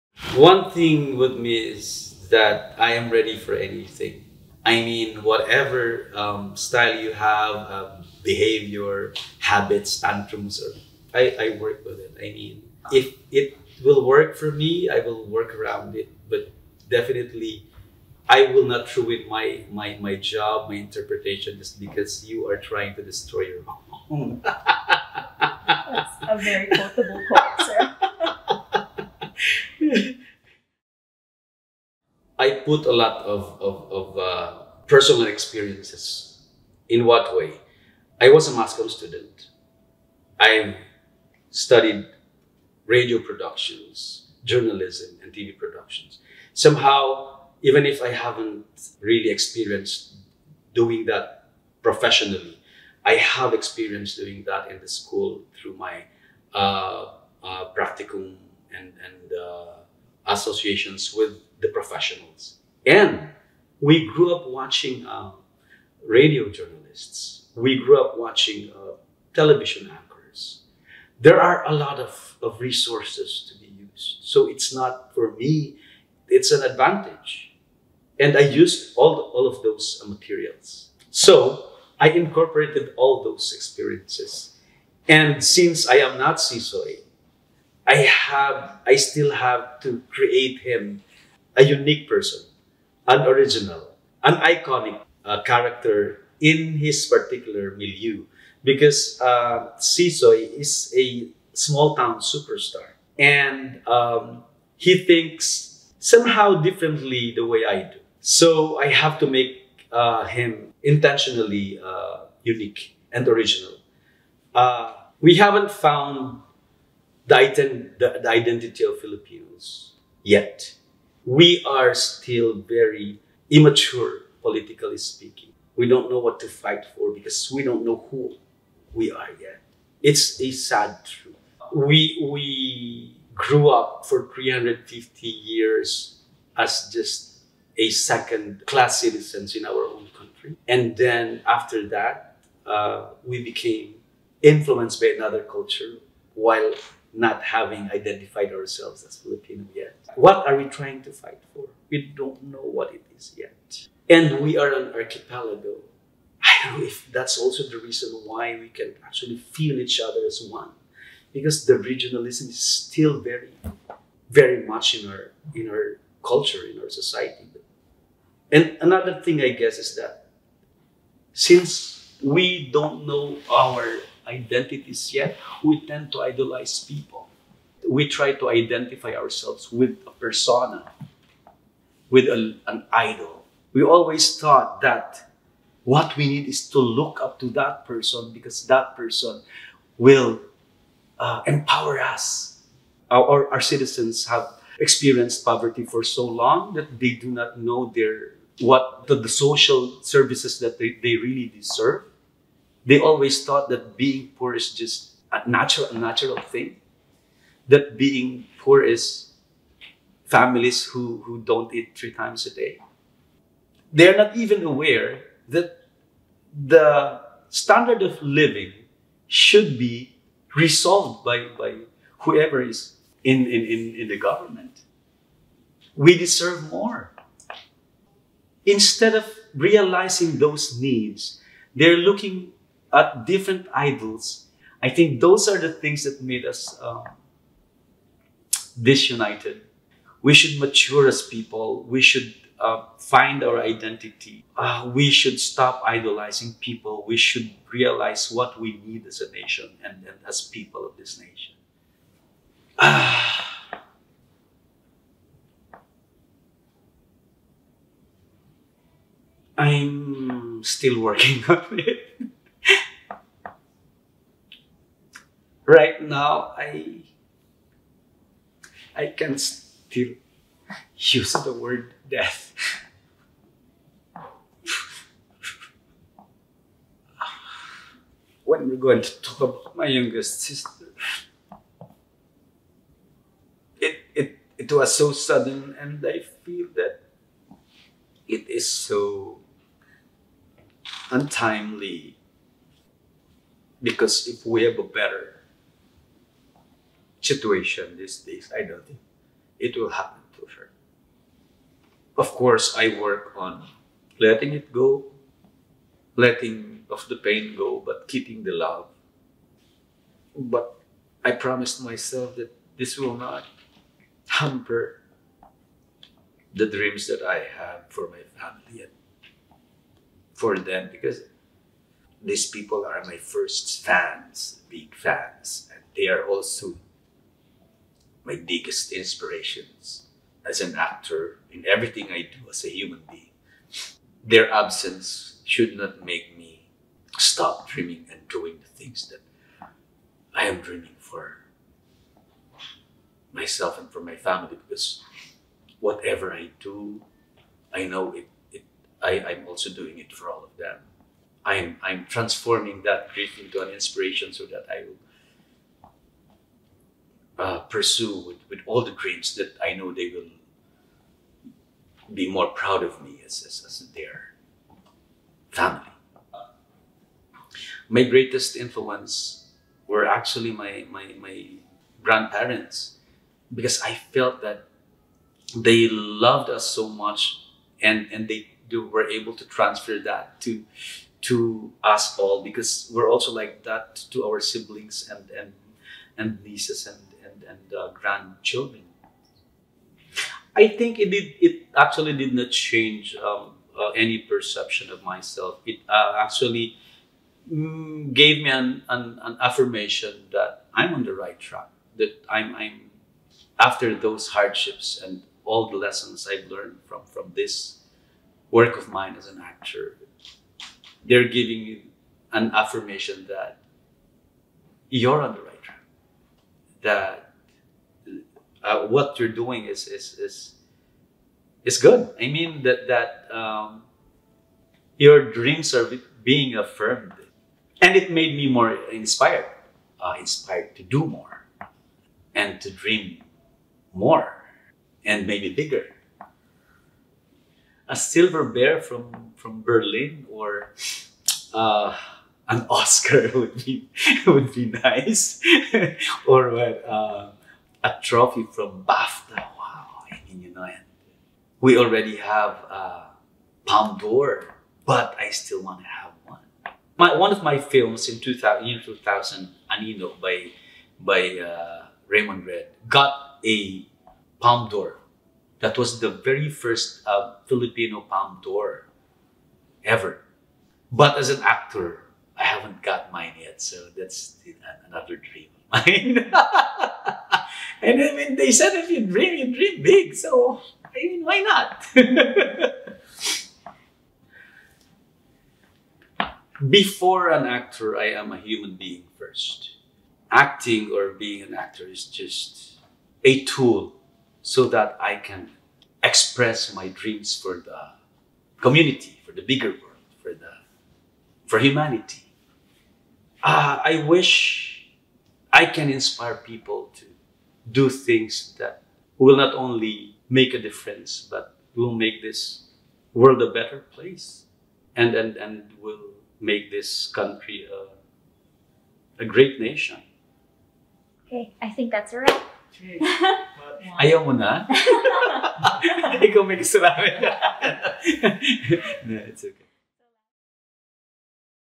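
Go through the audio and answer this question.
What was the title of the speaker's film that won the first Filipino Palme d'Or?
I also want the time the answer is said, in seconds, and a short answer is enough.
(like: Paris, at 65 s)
Anino, at 459 s.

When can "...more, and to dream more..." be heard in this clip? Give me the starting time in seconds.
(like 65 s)
431 s.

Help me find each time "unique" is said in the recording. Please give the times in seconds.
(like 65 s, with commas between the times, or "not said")
91 s, 112 s.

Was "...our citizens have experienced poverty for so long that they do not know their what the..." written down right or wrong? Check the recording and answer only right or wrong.
right.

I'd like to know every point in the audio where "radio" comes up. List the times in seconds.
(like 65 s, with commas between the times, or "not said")
42 s, 66 s.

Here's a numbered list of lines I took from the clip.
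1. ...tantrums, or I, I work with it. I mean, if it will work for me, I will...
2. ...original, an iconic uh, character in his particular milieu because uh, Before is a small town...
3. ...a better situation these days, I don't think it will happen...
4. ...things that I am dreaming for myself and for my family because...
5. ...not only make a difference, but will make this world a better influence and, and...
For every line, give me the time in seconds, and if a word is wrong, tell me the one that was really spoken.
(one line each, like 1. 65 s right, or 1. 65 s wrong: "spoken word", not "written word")
1. 9 s right
2. 93 s wrong: "Sisoy", not "Before"
3. 294 s right
4. 338 s right
5. 509 s wrong: "place", not "influence".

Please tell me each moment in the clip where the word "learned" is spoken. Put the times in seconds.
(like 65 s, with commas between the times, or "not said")
406 s.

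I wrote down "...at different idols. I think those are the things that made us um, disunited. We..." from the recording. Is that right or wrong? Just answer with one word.
right.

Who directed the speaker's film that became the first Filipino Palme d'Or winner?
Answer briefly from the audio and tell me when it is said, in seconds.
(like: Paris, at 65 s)
Raymond Red, at 462 s.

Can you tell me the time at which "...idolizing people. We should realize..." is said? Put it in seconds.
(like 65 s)
245 s.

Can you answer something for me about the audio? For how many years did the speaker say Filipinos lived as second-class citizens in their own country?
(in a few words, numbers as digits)
350.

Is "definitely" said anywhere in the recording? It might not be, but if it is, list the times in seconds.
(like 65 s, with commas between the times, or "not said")
16 s.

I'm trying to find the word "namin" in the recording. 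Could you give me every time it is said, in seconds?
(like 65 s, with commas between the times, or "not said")
526 s.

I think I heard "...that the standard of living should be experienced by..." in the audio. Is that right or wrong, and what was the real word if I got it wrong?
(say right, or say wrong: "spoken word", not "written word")
wrong: "resolved", not "experienced".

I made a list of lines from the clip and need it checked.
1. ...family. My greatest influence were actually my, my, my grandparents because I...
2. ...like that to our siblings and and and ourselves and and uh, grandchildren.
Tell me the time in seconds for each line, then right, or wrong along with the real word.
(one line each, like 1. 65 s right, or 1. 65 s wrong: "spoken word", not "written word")
1. 365 s right
2. 383 s wrong: "nieces", not "ourselves".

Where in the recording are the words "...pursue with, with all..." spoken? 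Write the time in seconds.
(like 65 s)
357 s.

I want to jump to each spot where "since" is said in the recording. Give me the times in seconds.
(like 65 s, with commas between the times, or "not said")
85 s, 171 s.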